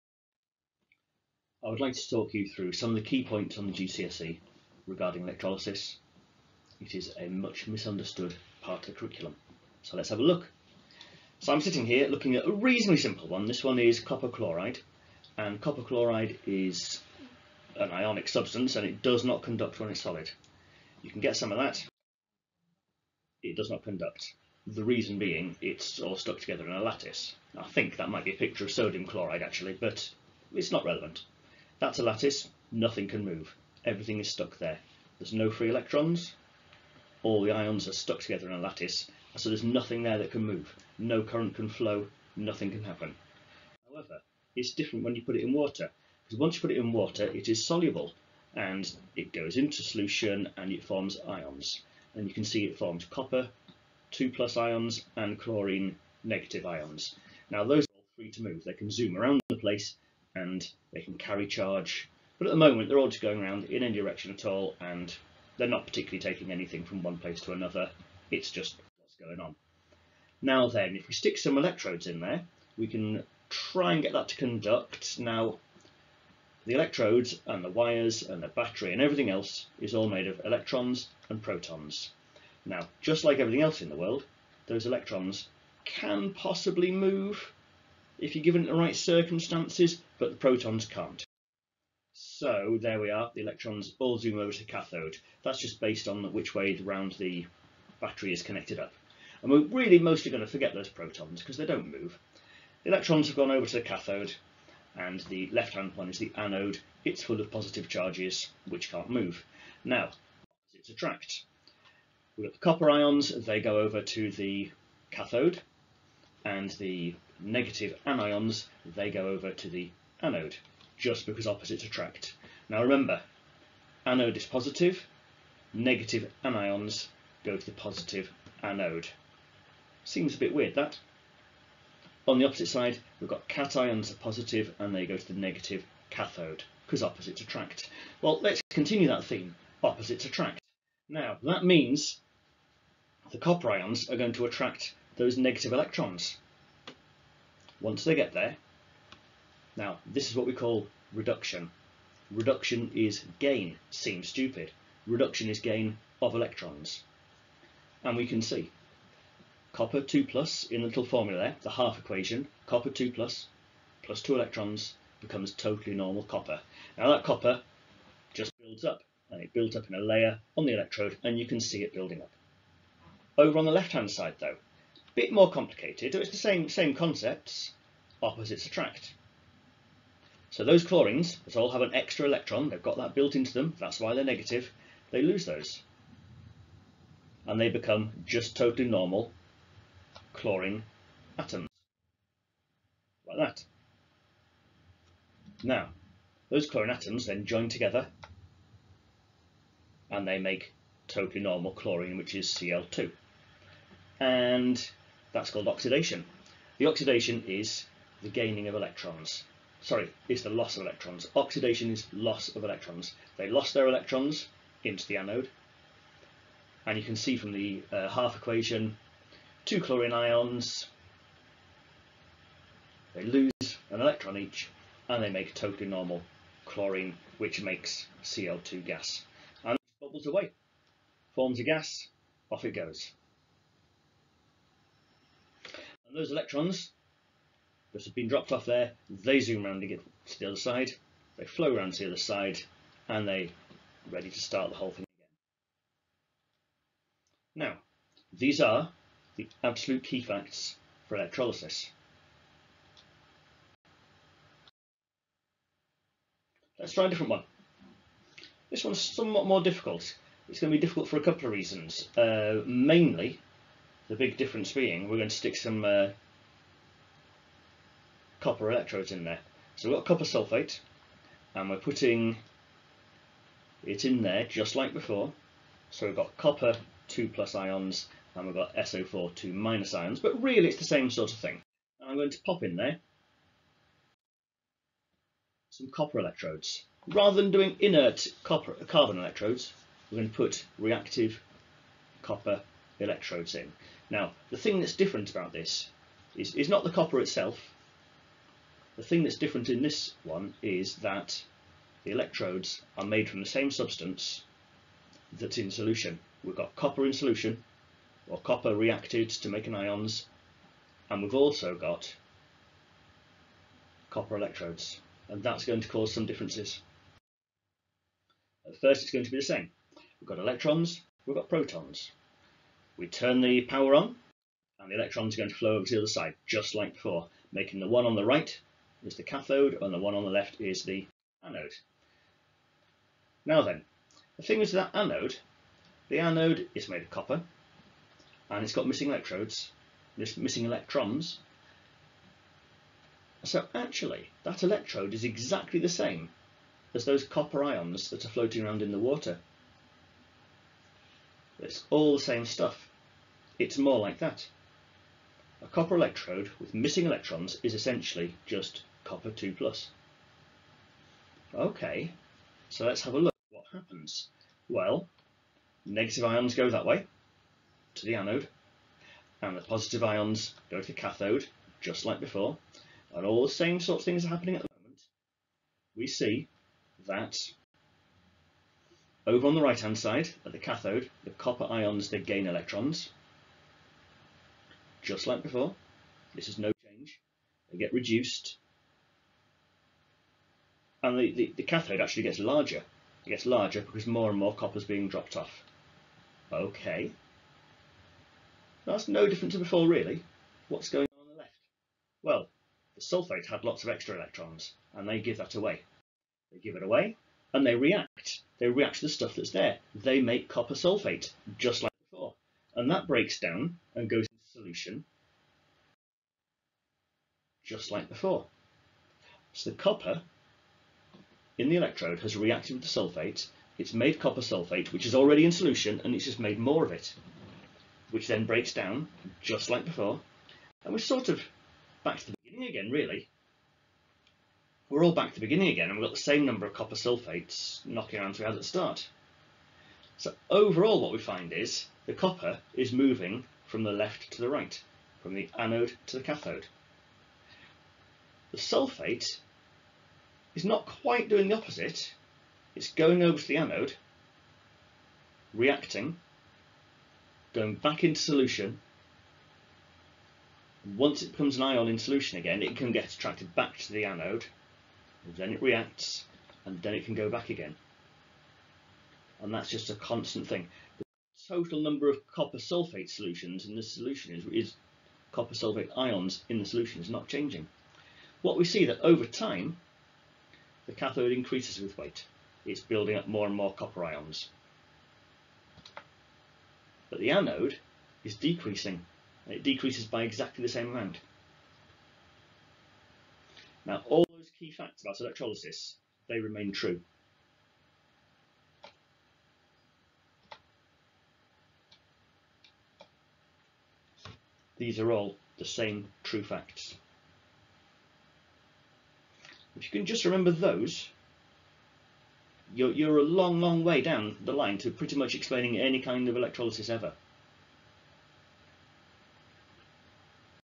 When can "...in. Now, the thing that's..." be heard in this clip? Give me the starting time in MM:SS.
04:53.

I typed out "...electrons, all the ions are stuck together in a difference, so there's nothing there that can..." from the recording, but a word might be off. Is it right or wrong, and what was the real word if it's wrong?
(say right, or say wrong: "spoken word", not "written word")
wrong: "lattice", not "difference".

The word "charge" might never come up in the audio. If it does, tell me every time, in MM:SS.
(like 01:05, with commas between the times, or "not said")
01:01, 01:47.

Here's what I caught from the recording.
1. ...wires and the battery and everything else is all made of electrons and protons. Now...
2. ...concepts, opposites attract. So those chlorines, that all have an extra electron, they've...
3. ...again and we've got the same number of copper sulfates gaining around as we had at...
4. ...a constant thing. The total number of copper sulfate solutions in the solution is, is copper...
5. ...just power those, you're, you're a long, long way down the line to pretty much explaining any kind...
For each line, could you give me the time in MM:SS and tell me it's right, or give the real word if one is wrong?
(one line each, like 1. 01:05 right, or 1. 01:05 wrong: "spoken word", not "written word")
1. 01:17 right
2. 02:56 right
3. 07:15 wrong: "knocking", not "gaining"
4. 07:49 right
5. 08:30 wrong: "remember", not "power".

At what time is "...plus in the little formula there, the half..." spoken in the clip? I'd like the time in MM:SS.
02:40.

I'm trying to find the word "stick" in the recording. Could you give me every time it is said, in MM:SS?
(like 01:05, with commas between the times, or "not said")
01:11, 04:25.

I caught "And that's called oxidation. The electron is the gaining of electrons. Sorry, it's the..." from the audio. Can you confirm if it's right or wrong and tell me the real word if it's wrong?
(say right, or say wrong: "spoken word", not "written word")
wrong: "oxidation", not "electron".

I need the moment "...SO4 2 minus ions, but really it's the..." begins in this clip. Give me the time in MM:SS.
04:38.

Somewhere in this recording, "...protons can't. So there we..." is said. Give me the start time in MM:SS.
01:30.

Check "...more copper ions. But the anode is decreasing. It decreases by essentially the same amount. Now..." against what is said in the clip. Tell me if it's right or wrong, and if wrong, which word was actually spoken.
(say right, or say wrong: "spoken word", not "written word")
wrong: "exactly", not "essentially".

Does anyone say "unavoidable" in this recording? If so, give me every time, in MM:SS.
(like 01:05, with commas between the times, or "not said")
not said.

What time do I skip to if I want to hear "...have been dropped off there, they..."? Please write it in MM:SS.
03:58.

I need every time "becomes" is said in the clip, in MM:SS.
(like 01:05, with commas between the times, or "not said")
02:45, 03:07, 07:41.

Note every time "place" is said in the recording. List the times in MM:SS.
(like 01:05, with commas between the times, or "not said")
00:59, 01:07.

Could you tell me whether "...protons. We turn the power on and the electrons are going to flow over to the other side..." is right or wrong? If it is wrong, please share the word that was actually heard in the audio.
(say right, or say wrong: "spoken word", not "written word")
right.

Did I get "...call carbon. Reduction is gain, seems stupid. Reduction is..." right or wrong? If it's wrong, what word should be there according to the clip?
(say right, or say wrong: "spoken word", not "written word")
wrong: "reduction", not "carbon".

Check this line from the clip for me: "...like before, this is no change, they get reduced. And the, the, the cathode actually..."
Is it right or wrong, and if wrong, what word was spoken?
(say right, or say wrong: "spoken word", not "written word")
right.